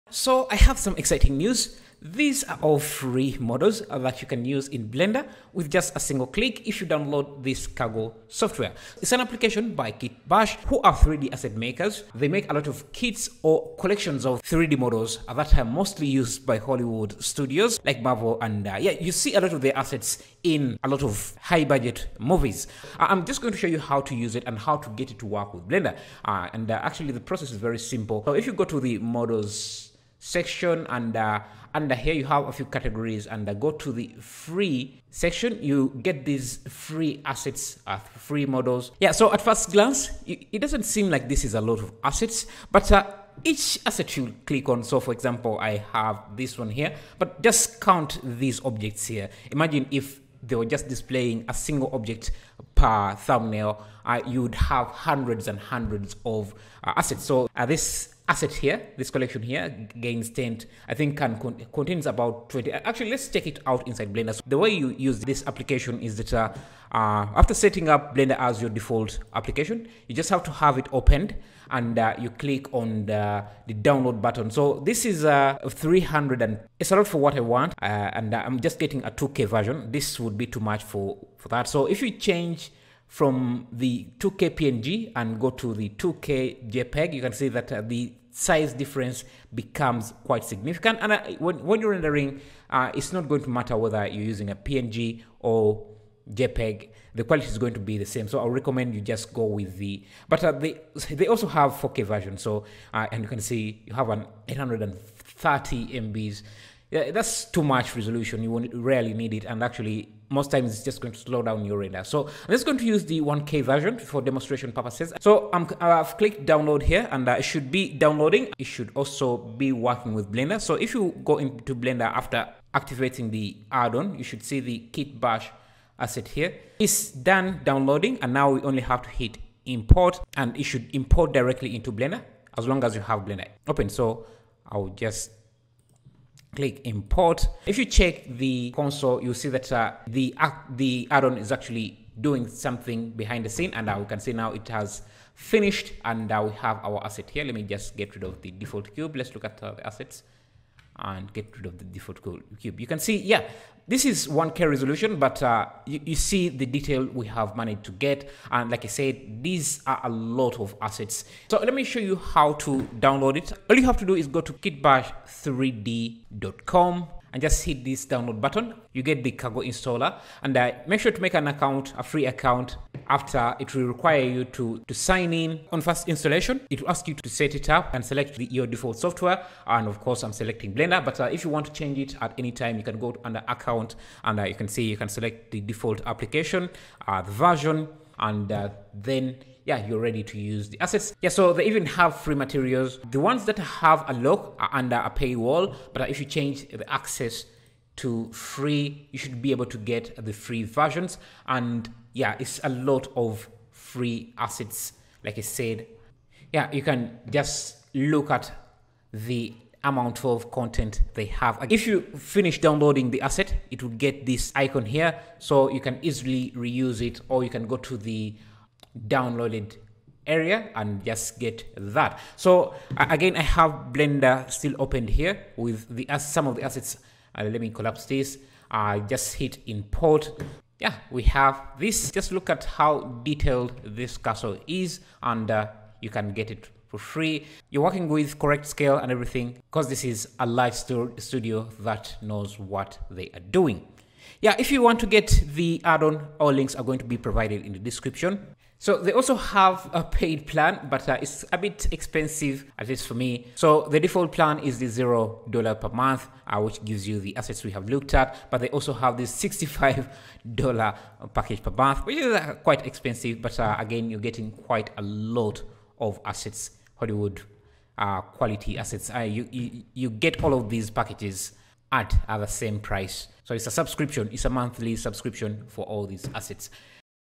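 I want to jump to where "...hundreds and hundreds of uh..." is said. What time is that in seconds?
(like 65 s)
54 s.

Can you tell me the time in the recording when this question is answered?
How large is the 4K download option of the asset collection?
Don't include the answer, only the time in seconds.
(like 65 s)
104 s.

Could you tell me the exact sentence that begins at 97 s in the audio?
The quality is going to be the same.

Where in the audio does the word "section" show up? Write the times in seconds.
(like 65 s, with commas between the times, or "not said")
30 s, 35 s.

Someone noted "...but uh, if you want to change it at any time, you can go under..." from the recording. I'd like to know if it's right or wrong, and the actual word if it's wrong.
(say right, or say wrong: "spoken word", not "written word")
right.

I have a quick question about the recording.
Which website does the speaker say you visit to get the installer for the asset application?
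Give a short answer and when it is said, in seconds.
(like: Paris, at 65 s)
kitbash3d.com, at 164 s.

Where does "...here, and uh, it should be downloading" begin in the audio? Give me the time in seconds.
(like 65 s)
116 s.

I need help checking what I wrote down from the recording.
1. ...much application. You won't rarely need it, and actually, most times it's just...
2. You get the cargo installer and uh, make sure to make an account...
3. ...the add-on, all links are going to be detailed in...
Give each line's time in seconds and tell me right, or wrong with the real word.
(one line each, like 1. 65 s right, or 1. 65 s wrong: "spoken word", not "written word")
1. 107 s wrong: "resolution", not "application"
2. 168 s right
3. 245 s wrong: "provided", not "detailed".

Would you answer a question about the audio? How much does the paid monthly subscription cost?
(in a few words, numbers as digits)
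$65.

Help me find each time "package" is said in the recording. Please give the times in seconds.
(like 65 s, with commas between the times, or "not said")
261 s, 270 s.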